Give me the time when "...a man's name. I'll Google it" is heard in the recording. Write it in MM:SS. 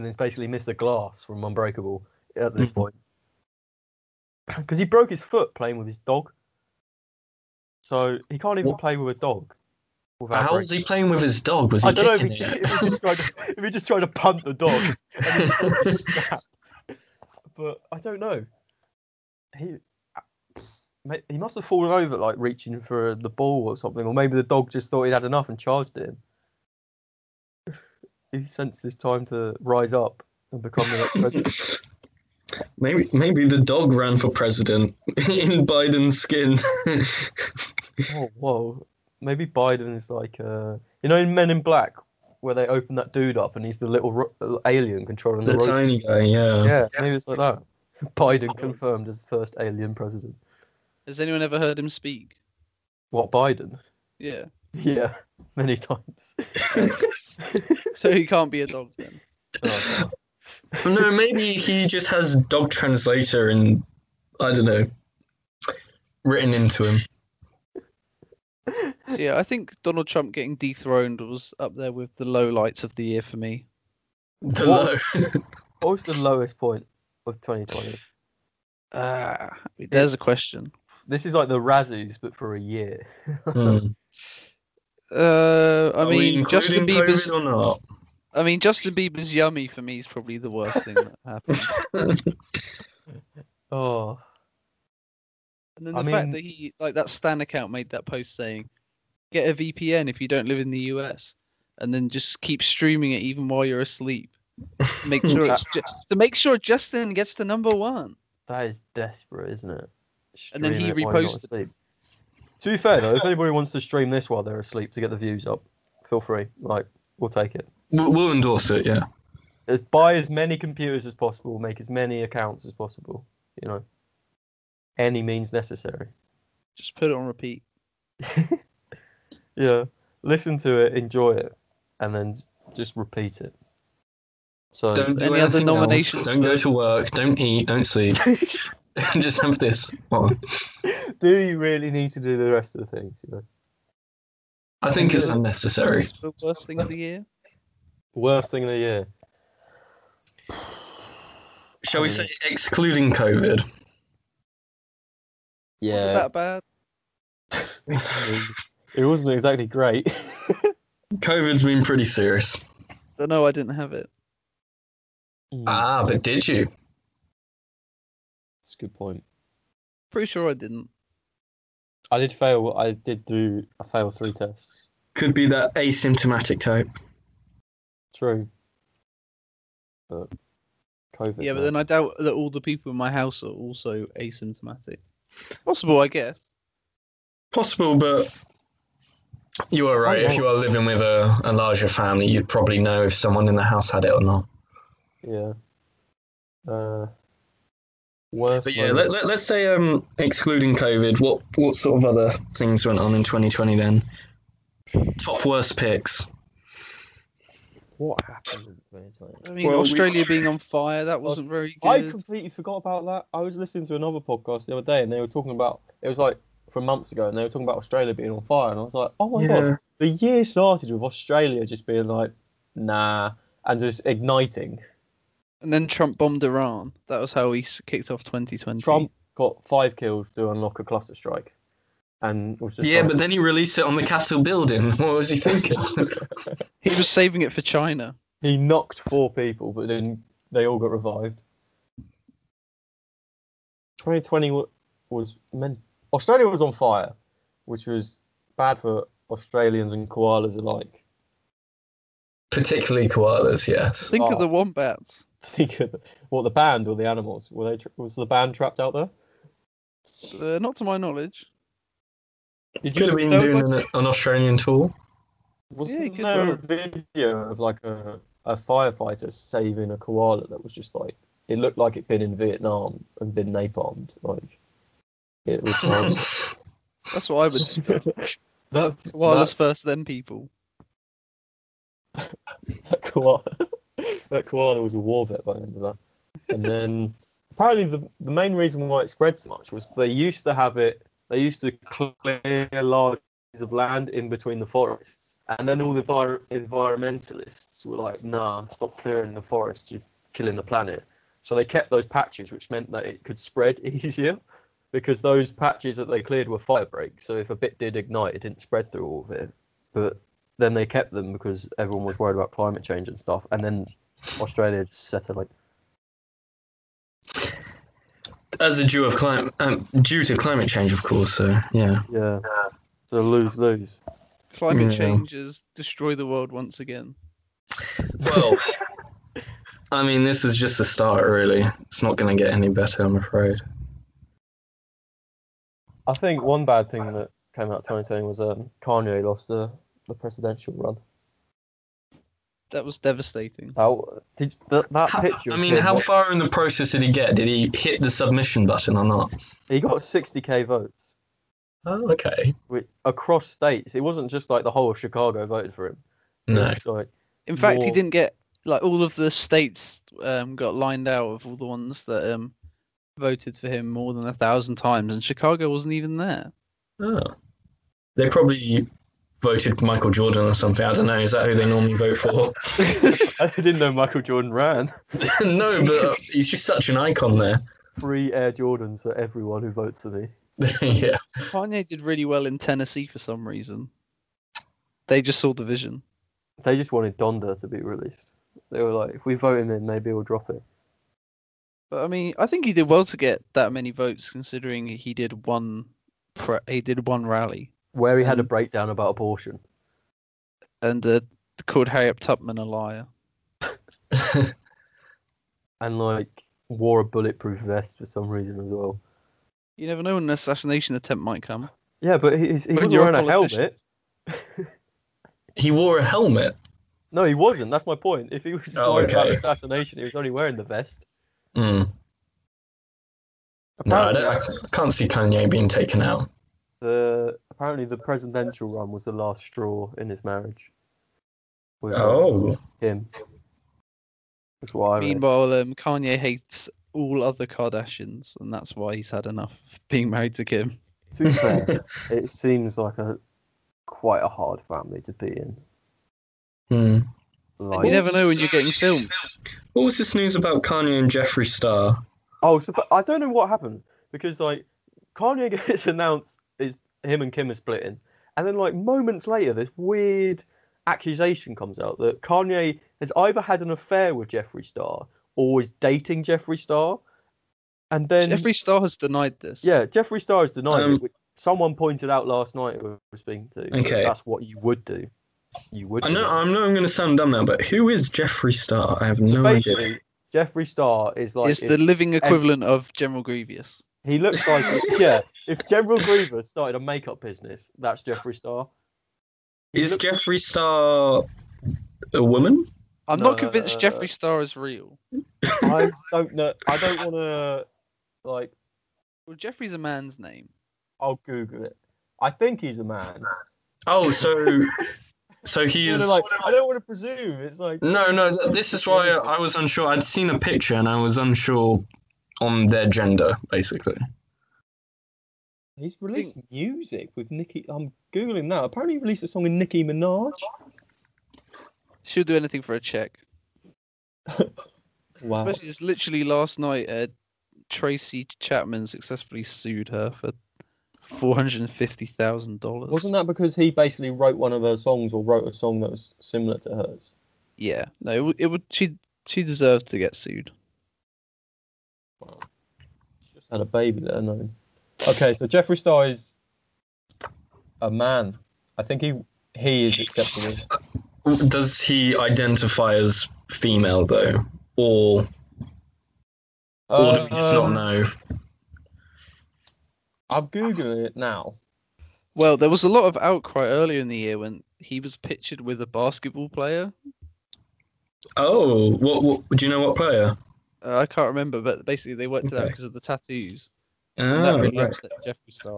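08:19.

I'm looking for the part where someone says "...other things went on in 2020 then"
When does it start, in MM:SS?
03:22.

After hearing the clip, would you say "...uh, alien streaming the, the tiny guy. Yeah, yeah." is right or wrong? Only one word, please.
wrong.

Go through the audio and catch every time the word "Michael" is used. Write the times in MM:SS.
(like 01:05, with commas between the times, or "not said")
06:09, 06:13.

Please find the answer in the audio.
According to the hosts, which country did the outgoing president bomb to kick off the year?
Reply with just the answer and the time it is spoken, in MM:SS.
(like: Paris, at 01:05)
Iran, at 03:46.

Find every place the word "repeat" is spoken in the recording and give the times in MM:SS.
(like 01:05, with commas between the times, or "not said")
02:07, 02:12.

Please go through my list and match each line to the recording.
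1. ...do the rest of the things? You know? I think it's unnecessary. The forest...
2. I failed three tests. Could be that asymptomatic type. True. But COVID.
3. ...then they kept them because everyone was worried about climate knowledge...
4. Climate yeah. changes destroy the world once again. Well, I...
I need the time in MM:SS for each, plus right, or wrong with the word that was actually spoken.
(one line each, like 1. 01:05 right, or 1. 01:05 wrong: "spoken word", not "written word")
1. 02:22 wrong: "worst", not "forest"
2. 02:53 right
3. 05:10 wrong: "change", not "knowledge"
4. 05:24 right.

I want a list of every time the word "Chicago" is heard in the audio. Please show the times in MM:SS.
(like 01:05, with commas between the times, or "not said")
05:54, 06:05.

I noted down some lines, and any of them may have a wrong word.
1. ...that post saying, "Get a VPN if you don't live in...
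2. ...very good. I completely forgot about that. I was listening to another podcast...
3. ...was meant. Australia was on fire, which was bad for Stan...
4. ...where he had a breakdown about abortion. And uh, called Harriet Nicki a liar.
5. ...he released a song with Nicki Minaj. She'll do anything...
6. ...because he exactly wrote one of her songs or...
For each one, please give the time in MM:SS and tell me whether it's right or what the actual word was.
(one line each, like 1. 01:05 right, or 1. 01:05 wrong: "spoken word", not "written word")
1. 01:37 right
2. 03:31 right
3. 04:05 wrong: "Australians", not "Stan"
4. 06:37 wrong: "Tubman", not "Nicki"
5. 08:38 right
6. 08:53 wrong: "basically", not "exactly".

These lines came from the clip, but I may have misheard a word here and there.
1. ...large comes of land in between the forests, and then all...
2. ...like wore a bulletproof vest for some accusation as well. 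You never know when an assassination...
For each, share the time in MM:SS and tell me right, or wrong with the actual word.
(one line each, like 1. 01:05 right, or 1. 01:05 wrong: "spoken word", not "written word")
1. 04:52 wrong: "pieces", not "comes"
2. 06:45 wrong: "reason", not "accusation".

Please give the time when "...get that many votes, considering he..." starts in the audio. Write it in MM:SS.
06:33.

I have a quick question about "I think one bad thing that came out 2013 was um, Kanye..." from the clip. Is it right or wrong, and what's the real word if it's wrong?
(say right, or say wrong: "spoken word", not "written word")
wrong: "2020", not "2013".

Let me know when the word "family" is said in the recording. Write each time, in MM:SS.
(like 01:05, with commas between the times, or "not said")
03:11, 07:24.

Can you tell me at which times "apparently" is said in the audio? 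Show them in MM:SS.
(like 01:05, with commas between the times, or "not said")
04:47, 07:07, 08:38.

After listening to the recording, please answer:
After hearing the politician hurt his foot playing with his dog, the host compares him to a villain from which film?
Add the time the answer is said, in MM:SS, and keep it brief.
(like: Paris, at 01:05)
Unbreakable, at 00:01.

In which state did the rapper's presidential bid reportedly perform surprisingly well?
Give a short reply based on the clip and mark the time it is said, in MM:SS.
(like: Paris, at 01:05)
Tennessee, at 06:22.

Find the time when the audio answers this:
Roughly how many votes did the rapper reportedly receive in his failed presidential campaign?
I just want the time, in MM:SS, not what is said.
05:49.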